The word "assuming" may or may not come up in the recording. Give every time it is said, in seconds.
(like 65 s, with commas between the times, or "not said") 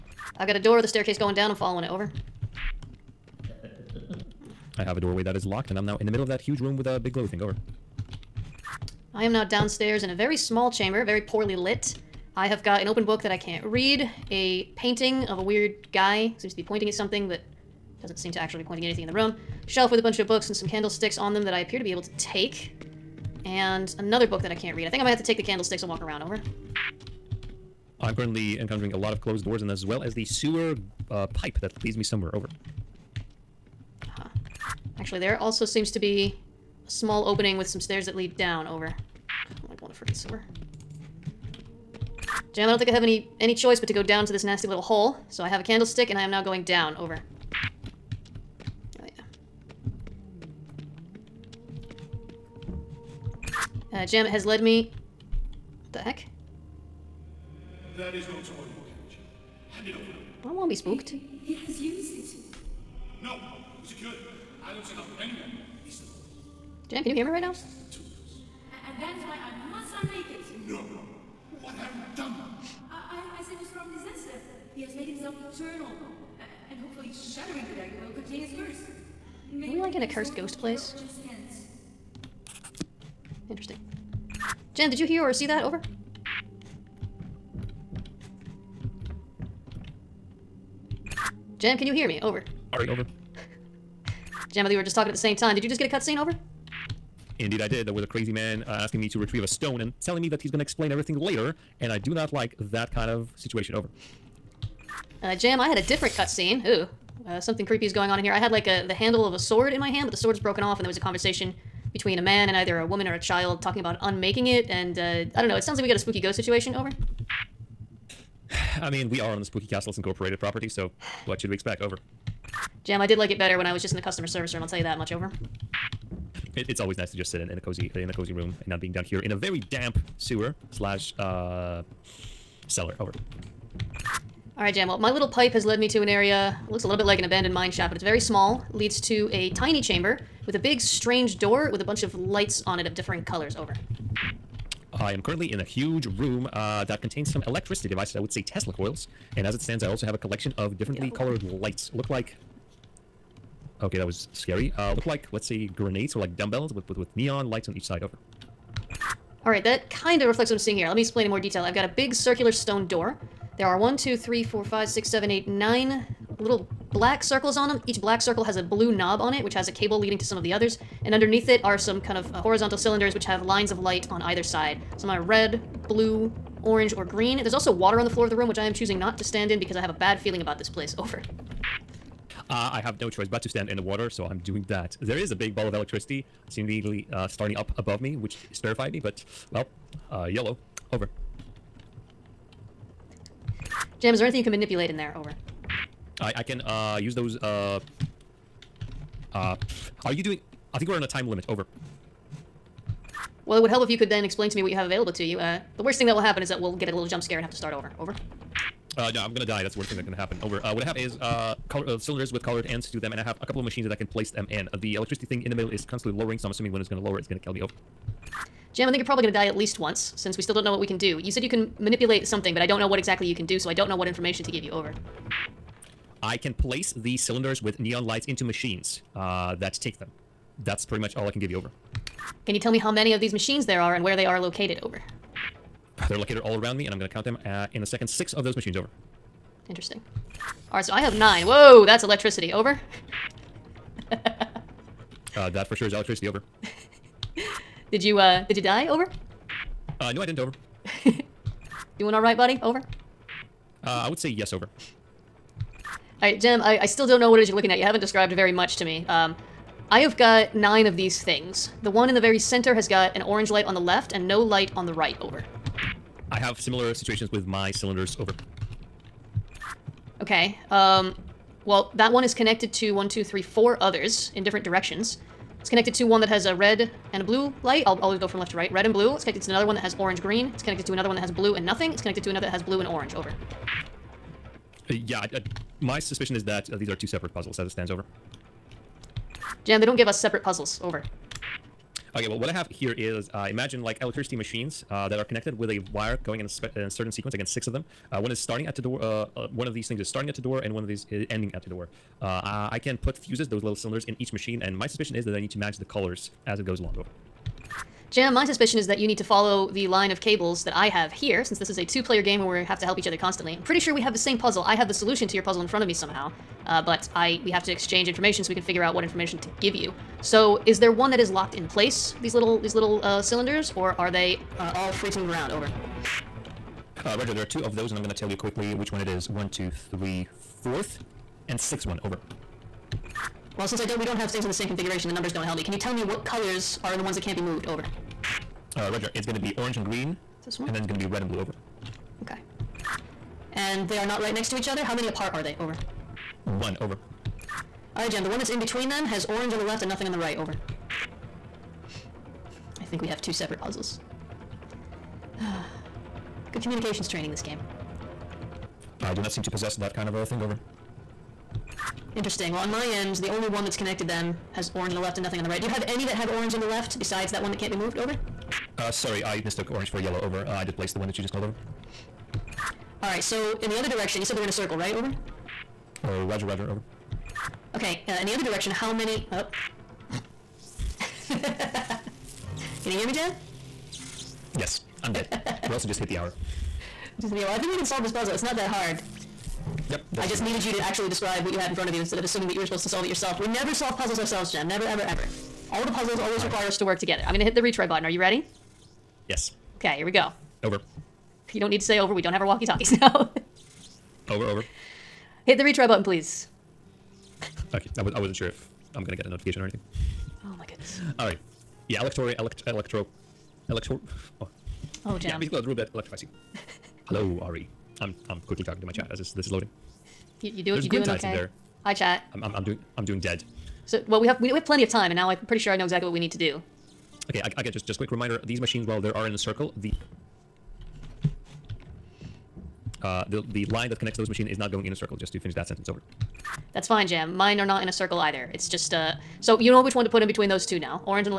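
216 s, 392 s.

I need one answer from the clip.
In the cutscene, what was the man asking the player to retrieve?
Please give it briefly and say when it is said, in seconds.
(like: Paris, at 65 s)
a stone, at 99 s.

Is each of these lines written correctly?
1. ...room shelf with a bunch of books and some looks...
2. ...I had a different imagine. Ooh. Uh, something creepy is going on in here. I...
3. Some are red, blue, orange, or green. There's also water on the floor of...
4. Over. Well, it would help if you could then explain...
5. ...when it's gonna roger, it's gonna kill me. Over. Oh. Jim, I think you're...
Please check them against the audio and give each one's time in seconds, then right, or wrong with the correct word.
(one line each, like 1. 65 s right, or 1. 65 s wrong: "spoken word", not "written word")
1. 19 s wrong: "candlesticks", not "looks"
2. 105 s wrong: "cutscene", not "imagine"
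3. 174 s right
4. 201 s right
5. 216 s wrong: "lower", not "roger".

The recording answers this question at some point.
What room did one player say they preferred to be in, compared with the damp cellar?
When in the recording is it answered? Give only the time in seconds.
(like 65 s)
124 s.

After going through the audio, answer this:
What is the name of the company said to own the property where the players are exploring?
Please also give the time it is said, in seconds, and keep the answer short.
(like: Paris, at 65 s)
Spooky Castles Incorporated, at 119 s.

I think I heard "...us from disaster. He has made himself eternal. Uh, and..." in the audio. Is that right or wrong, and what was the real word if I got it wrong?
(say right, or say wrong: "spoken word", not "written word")
right.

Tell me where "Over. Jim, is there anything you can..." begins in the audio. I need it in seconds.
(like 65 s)
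190 s.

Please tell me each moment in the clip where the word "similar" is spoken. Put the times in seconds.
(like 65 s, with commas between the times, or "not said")
266 s.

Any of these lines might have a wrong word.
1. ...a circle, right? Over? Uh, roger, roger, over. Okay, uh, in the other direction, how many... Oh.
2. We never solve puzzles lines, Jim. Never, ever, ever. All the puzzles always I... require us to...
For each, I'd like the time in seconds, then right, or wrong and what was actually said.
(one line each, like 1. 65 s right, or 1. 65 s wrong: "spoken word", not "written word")
1. 374 s right
2. 393 s wrong: "ourselves", not "lines".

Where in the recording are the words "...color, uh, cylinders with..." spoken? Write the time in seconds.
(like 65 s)
211 s.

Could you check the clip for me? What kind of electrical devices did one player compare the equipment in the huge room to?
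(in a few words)
Tesla coils.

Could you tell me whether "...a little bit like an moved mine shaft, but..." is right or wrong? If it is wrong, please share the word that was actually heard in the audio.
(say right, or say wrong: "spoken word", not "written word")
wrong: "abandoned", not "moved".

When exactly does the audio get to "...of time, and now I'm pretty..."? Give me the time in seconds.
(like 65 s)
424 s.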